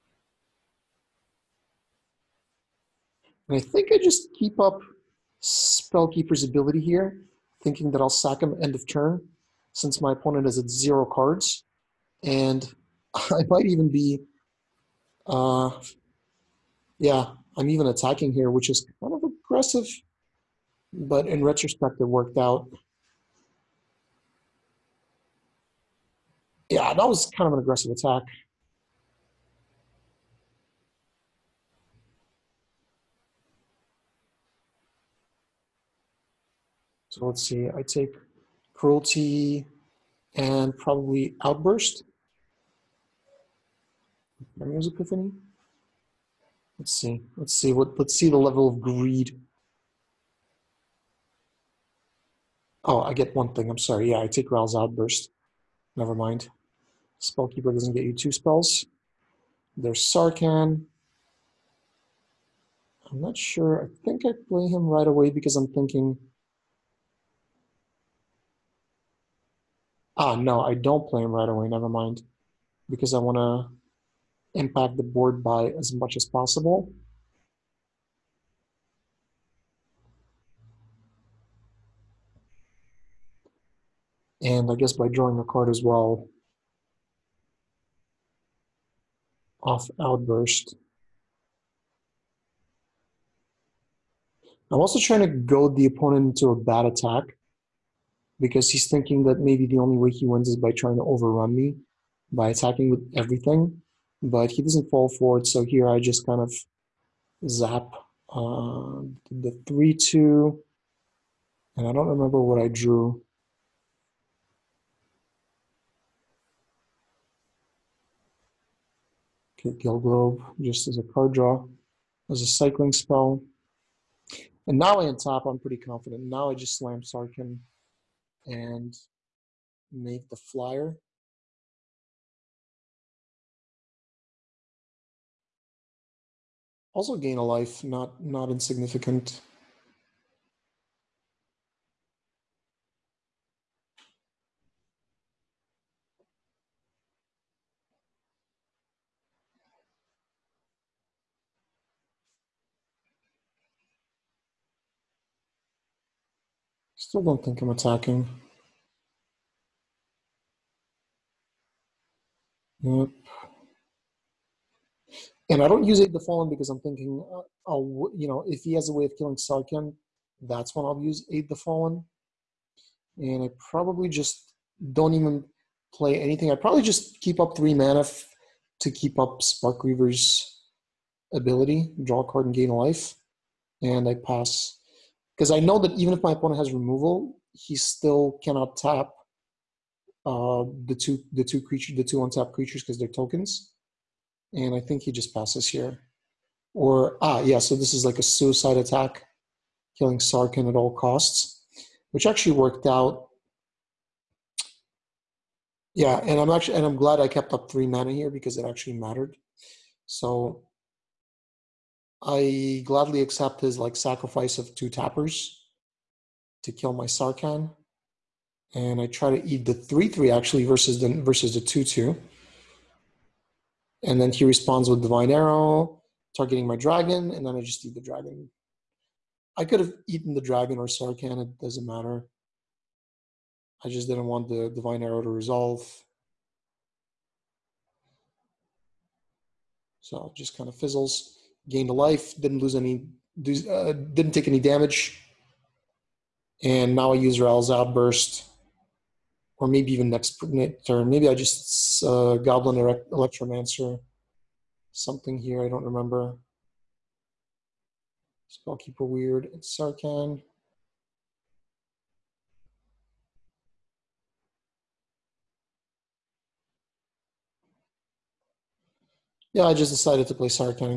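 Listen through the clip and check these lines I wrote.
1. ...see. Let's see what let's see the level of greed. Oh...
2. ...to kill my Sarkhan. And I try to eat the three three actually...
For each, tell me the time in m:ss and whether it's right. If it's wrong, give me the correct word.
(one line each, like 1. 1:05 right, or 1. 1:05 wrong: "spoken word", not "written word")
1. 0:46 right
2. 3:36 right.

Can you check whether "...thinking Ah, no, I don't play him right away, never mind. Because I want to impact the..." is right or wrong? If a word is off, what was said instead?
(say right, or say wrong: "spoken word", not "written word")
right.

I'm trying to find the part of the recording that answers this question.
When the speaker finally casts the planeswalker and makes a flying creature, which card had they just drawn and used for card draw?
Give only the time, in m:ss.
1:59.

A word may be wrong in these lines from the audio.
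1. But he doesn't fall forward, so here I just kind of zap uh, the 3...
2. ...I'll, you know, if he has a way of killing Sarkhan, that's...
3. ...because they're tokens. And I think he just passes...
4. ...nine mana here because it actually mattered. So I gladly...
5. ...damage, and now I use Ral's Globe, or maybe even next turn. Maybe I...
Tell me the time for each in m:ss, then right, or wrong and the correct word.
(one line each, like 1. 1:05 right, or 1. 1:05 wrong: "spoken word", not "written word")
1. 1:44 right
2. 2:47 right
3. 3:12 right
4. 3:27 wrong: "three", not "nine"
5. 4:04 wrong: "Outburst", not "Globe".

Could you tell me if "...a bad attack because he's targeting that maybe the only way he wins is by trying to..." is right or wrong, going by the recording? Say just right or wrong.
wrong.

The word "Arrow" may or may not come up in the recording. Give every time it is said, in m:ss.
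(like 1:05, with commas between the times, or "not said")
3:45, 3:55.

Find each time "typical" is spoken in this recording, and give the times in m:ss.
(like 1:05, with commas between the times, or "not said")
not said.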